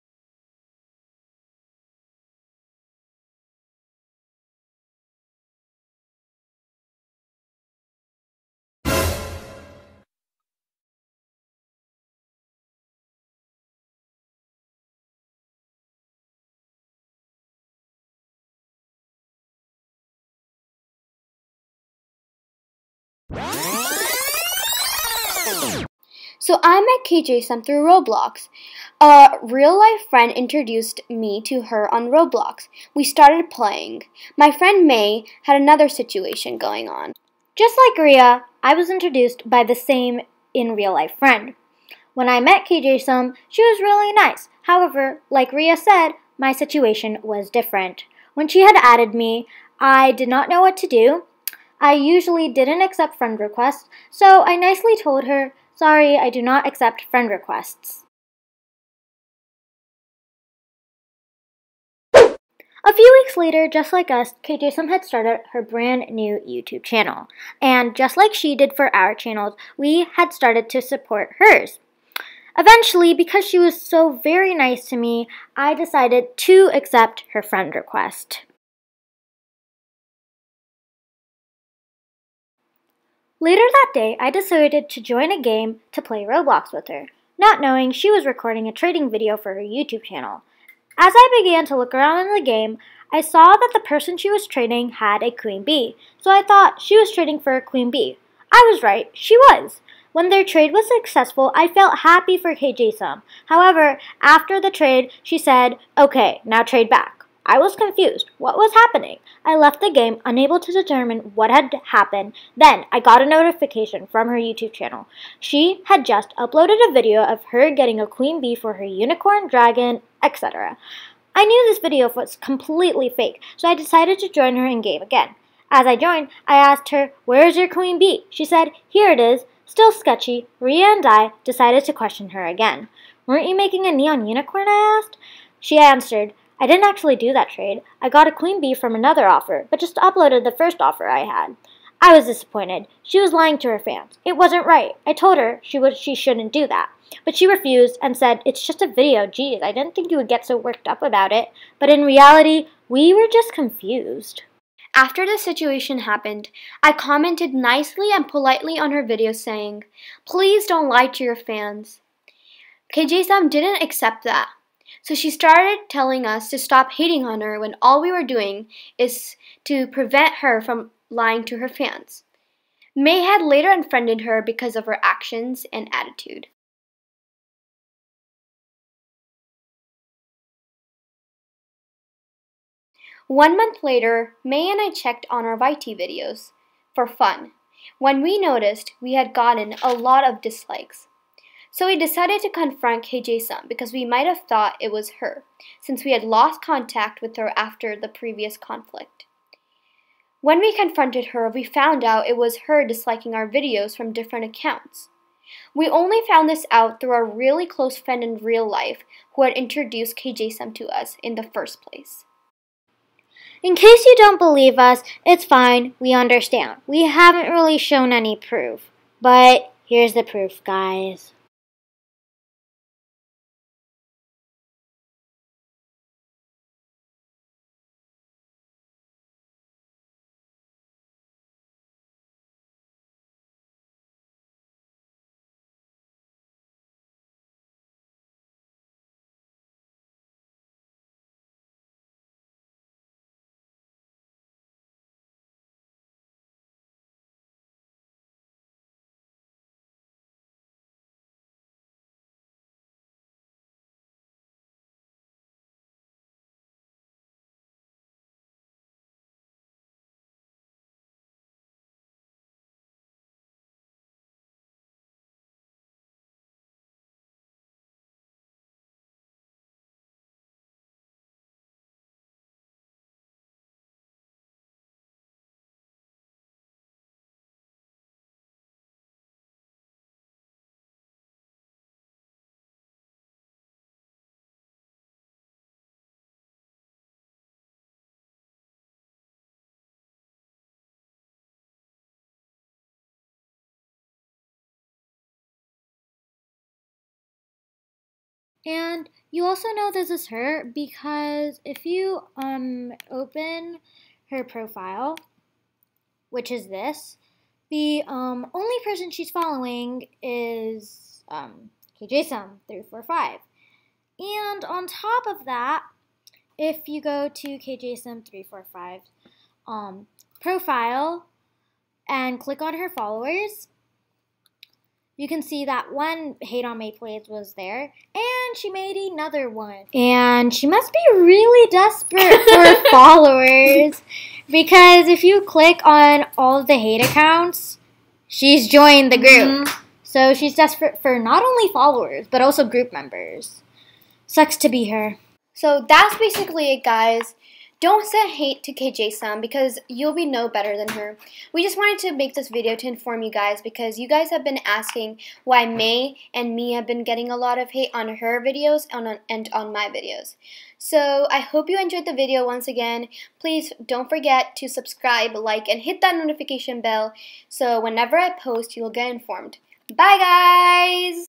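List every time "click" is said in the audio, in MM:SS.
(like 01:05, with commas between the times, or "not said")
05:22, 05:35.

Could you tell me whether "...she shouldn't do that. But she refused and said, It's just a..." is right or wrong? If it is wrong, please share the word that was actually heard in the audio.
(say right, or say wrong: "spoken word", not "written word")
right.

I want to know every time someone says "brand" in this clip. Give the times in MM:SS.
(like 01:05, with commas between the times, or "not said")
01:05.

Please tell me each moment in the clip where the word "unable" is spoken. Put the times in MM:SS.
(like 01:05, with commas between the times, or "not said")
01:50.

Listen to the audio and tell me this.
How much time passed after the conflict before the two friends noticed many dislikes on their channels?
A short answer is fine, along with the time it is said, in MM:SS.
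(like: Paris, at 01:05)
One month, at 03:03.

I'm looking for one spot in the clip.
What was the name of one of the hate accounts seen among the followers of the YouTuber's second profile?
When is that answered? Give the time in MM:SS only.
05:26.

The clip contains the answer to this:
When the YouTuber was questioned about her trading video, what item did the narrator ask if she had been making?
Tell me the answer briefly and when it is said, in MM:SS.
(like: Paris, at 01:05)
neon unicorn, at 02:13.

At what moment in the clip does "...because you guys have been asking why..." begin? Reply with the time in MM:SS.
05:53.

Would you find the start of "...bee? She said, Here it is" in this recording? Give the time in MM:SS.
02:07.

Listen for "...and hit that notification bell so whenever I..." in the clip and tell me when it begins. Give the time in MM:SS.
06:05.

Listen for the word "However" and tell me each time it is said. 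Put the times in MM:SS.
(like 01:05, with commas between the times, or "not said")
00:44, 01:43.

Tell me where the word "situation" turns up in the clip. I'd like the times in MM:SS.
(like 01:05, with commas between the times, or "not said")
00:35, 00:46, 02:35.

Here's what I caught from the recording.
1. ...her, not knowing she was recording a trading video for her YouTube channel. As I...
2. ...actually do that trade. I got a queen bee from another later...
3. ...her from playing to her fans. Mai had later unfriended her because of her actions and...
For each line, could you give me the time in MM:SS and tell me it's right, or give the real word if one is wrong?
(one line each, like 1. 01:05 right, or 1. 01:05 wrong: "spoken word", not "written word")
1. 01:26 right
2. 02:16 wrong: "offer", not "later"
3. 02:50 wrong: "lying", not "playing".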